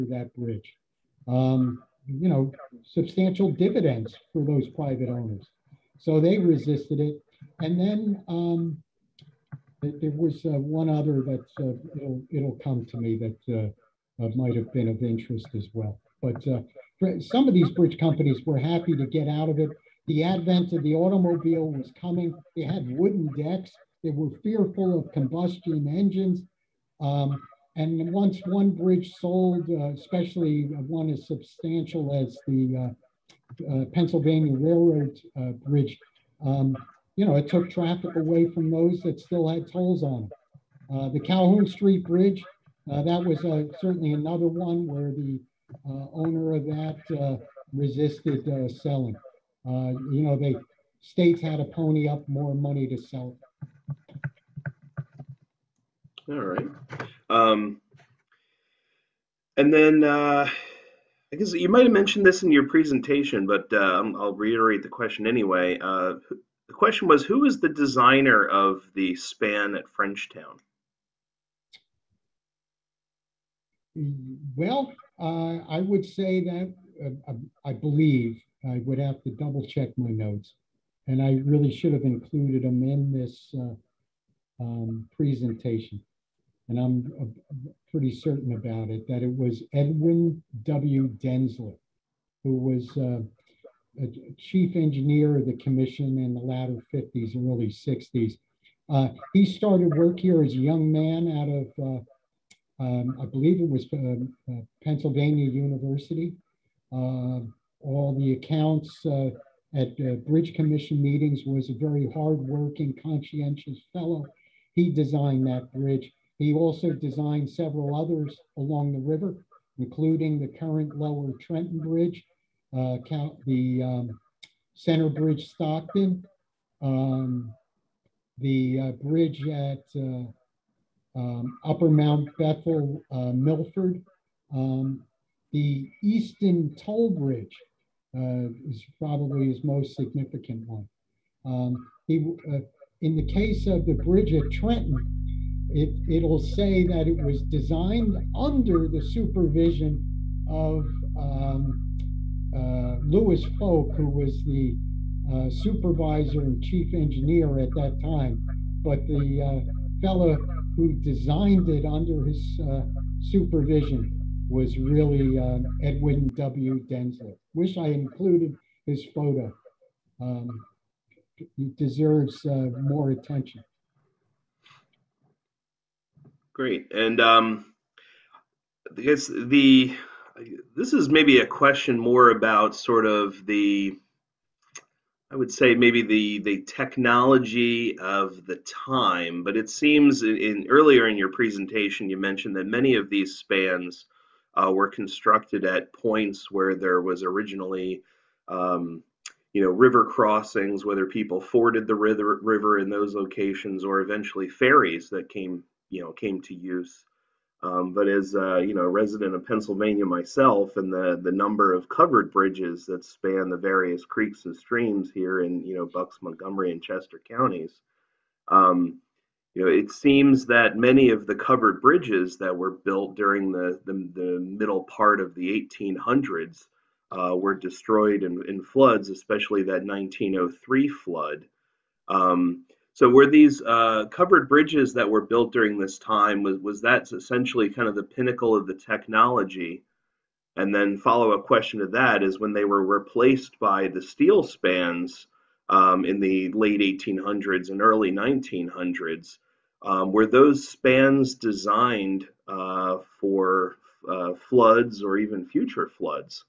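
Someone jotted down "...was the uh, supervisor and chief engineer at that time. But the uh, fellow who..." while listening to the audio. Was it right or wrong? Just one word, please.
right.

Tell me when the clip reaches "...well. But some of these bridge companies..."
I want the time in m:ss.
0:15.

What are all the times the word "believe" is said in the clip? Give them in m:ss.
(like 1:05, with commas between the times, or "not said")
1:17, 1:43.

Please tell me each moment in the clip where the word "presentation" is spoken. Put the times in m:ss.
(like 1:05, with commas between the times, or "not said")
1:02, 1:25, 3:11.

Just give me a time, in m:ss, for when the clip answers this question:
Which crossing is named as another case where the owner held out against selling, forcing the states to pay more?
0:41.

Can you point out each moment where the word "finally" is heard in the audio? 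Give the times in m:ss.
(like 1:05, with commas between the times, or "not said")
not said.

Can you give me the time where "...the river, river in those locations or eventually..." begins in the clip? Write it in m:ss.
3:21.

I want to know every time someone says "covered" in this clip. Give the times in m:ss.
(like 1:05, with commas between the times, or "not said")
3:31, 3:41, 3:54.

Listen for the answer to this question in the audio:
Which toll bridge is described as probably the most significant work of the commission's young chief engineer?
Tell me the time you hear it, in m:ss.
2:16.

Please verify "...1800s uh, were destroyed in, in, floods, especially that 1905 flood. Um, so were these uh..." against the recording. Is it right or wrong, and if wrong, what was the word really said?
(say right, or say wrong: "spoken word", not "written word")
wrong: "1903", not "1905".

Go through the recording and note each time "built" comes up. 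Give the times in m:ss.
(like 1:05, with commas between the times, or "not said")
3:42, 3:55.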